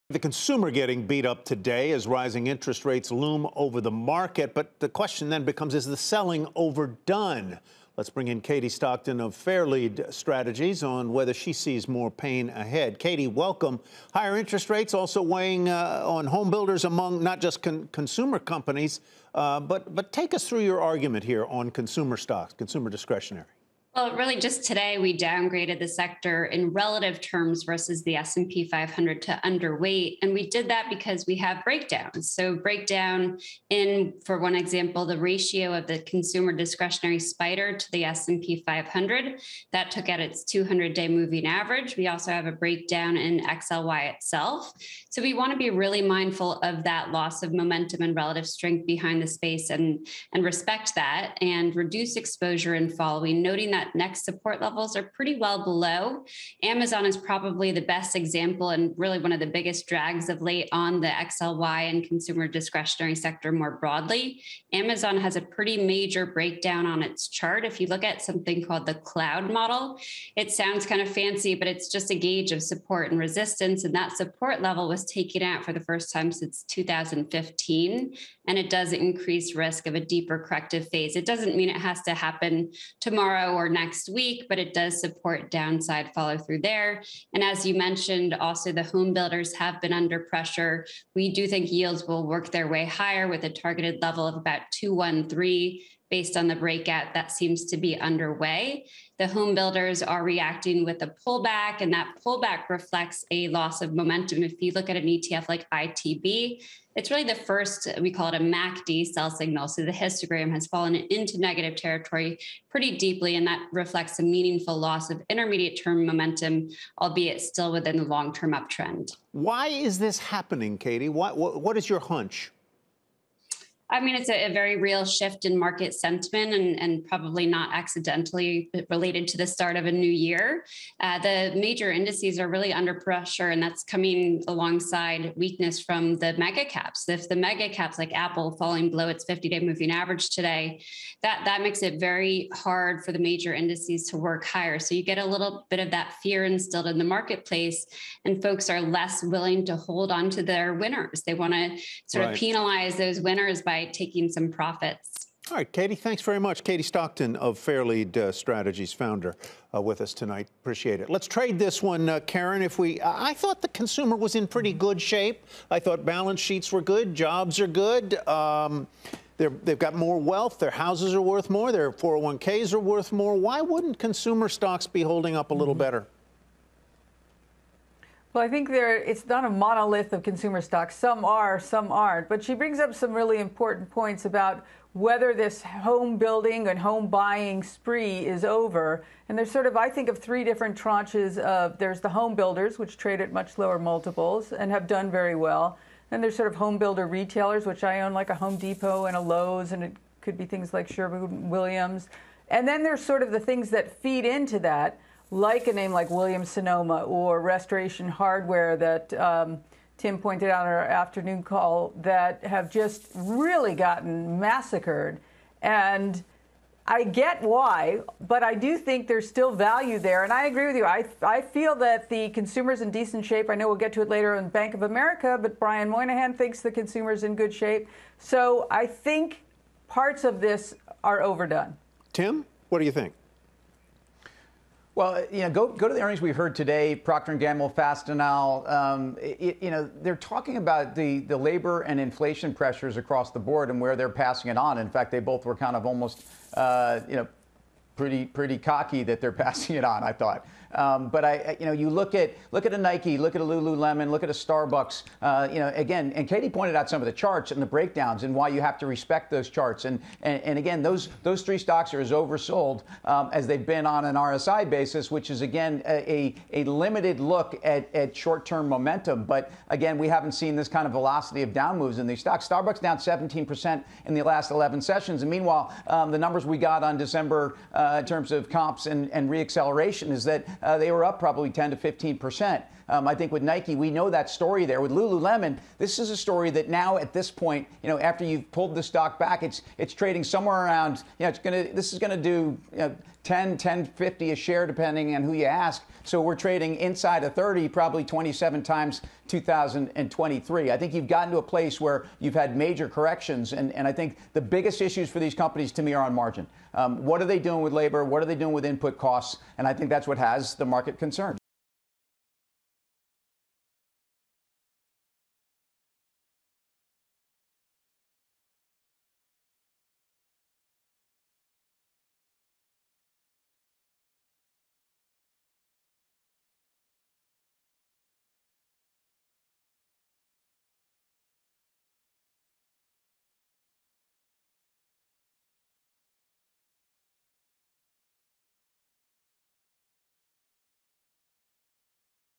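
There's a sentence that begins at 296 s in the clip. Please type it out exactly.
So we're trading inside of 30, probably 27 times 2023.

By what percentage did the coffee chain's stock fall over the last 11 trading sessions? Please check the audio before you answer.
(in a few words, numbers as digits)
17 percent.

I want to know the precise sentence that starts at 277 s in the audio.
Uh, uh, in terms of comps and, and reacceleration is that uh, they were up probably 10 to 15 percent.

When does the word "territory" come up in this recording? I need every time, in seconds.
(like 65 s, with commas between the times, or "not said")
111 s.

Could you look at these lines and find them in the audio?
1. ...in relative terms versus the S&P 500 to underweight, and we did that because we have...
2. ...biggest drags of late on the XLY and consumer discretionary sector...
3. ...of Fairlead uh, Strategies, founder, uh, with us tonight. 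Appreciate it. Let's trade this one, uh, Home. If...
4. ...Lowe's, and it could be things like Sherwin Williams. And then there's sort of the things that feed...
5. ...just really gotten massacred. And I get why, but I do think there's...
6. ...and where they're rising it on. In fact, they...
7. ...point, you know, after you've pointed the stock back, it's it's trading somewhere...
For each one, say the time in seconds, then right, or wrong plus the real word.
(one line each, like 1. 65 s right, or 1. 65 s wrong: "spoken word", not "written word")
1. 26 s right
2. 59 s right
3. 157 s wrong: "Karen", not "Home"
4. 199 s right
5. 212 s right
6. 243 s wrong: "passing", not "rising"
7. 287 s wrong: "pulled", not "pointed".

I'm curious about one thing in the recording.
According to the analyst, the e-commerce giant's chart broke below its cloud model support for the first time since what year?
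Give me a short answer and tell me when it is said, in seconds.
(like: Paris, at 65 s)
2015, at 76 s.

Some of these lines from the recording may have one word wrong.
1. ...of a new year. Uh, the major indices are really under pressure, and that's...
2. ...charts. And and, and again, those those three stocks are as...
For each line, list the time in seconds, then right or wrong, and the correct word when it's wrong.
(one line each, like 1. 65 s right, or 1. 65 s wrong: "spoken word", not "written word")
1. 129 s right
2. 259 s right.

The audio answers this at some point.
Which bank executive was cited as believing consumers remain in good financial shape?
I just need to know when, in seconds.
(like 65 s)
225 s.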